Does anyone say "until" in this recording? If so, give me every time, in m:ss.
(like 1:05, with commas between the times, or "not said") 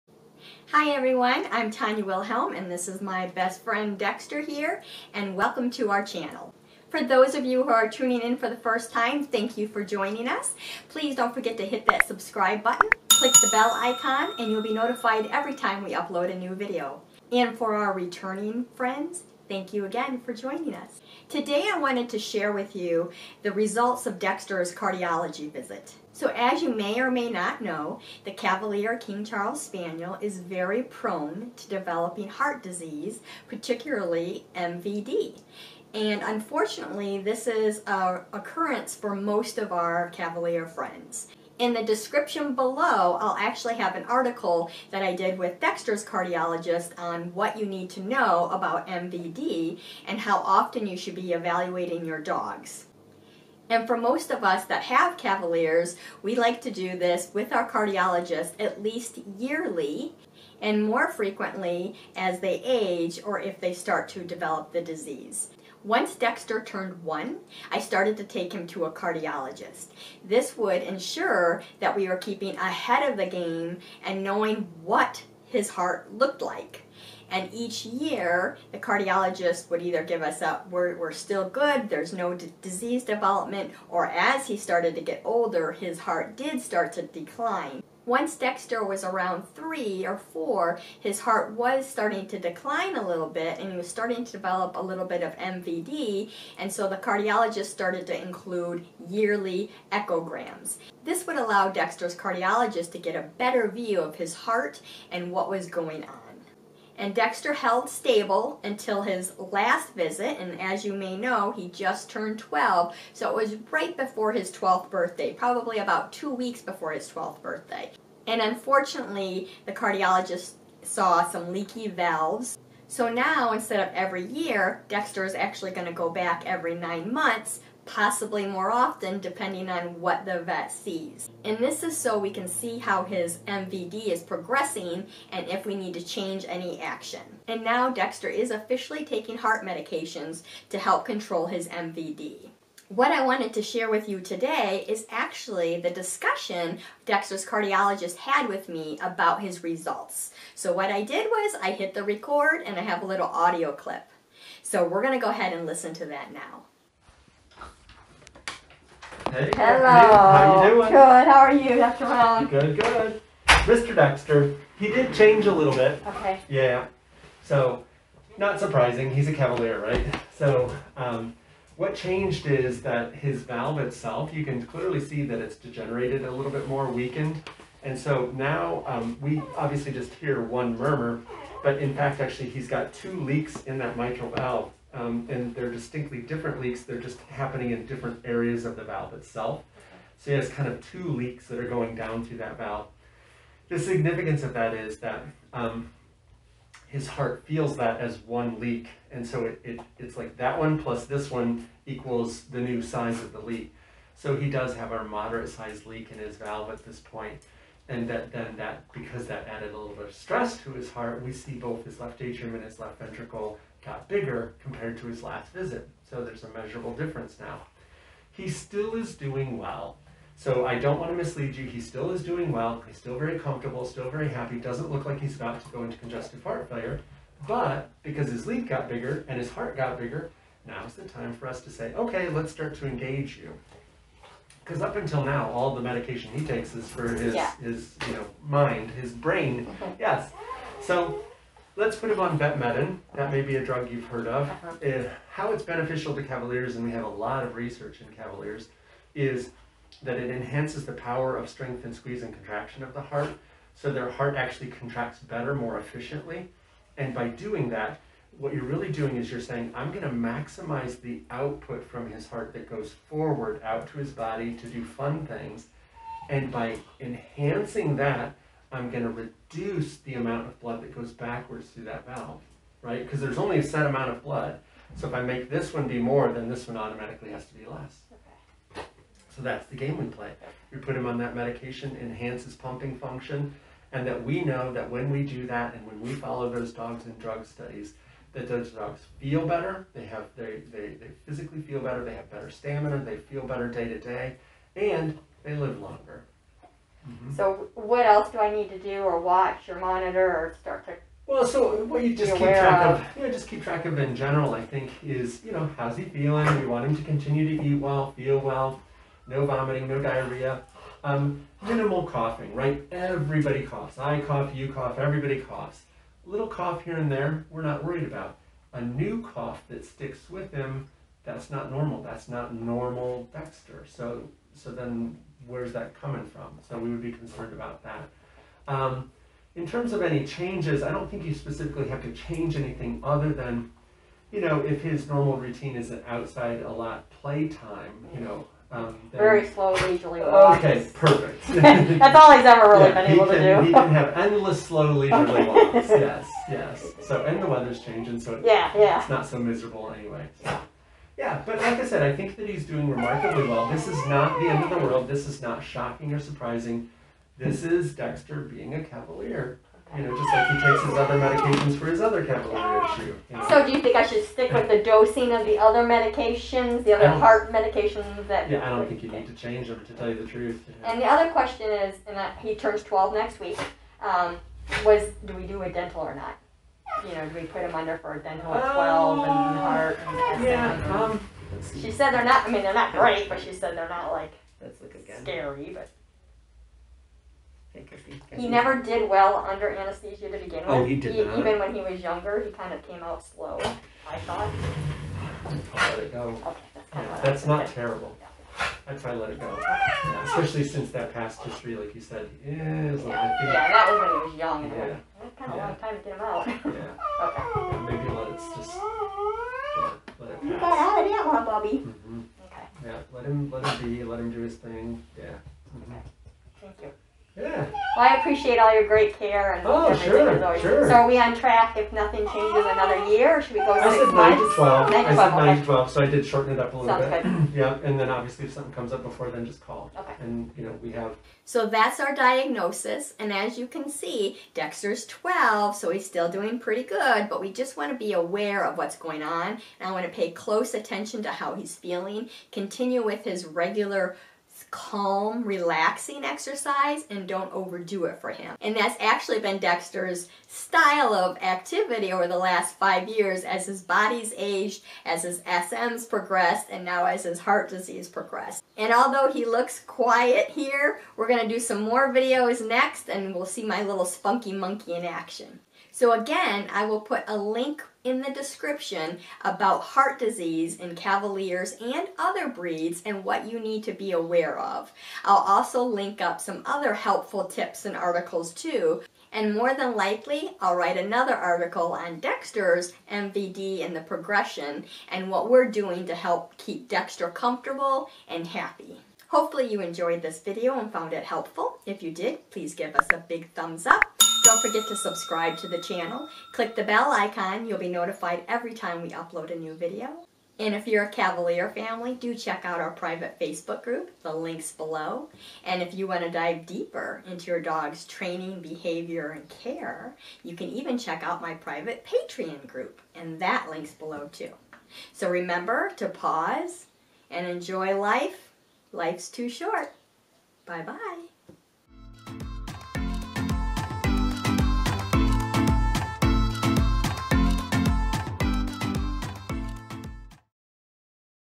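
1:48, 3:54.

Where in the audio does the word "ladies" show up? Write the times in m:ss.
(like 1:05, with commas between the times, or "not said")
not said.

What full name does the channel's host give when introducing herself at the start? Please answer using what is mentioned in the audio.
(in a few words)
Tonya Wilhelm.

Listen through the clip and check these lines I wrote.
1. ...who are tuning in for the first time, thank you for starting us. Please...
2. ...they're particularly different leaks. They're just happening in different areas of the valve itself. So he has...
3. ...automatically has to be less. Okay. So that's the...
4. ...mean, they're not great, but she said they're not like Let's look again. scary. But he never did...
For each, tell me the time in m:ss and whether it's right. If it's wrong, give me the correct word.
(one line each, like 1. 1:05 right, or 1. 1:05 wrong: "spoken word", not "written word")
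1. 0:07 wrong: "joining", not "starting"
2. 3:05 wrong: "distinctly", not "particularly"
3. 4:36 right
4. 6:22 right.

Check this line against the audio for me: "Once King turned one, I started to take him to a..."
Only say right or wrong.
wrong.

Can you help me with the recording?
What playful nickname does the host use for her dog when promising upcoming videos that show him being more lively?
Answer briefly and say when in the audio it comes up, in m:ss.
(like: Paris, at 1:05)
spunky monkey, at 7:44.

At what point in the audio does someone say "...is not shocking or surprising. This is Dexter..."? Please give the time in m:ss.
5:55.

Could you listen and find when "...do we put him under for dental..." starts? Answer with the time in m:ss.
6:17.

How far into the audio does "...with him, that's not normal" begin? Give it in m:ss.
5:20.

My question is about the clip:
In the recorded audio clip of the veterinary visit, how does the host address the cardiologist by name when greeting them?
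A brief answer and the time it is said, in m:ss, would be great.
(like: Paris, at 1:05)
Dr. Malone, at 2:41.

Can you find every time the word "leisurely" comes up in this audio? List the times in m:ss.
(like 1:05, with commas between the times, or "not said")
5:39, 5:44.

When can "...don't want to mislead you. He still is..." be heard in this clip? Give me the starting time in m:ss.
3:40.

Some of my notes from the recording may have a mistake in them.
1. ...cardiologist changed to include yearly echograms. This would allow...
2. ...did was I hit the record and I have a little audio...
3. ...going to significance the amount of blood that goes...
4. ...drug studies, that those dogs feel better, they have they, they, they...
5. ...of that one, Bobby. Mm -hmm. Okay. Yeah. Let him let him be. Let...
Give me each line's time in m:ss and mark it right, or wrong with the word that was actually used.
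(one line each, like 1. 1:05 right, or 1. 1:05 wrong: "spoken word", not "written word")
1. 1:36 wrong: "started", not "changed"
2. 2:31 right
3. 4:28 wrong: "reduce", not "significance"
4. 4:47 right
5. 6:51 right.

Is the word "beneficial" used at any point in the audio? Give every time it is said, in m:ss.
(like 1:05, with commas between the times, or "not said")
4:05.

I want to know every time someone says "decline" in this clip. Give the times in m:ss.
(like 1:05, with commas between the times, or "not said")
1:27, 1:32.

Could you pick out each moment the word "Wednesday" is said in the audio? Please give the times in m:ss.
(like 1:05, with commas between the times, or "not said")
not said.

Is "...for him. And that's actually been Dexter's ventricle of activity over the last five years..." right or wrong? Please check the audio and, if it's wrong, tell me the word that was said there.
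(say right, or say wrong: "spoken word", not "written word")
wrong: "style", not "ventricle".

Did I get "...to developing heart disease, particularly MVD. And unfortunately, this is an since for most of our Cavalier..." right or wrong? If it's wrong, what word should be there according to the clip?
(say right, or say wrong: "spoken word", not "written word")
wrong: "occurrence", not "since".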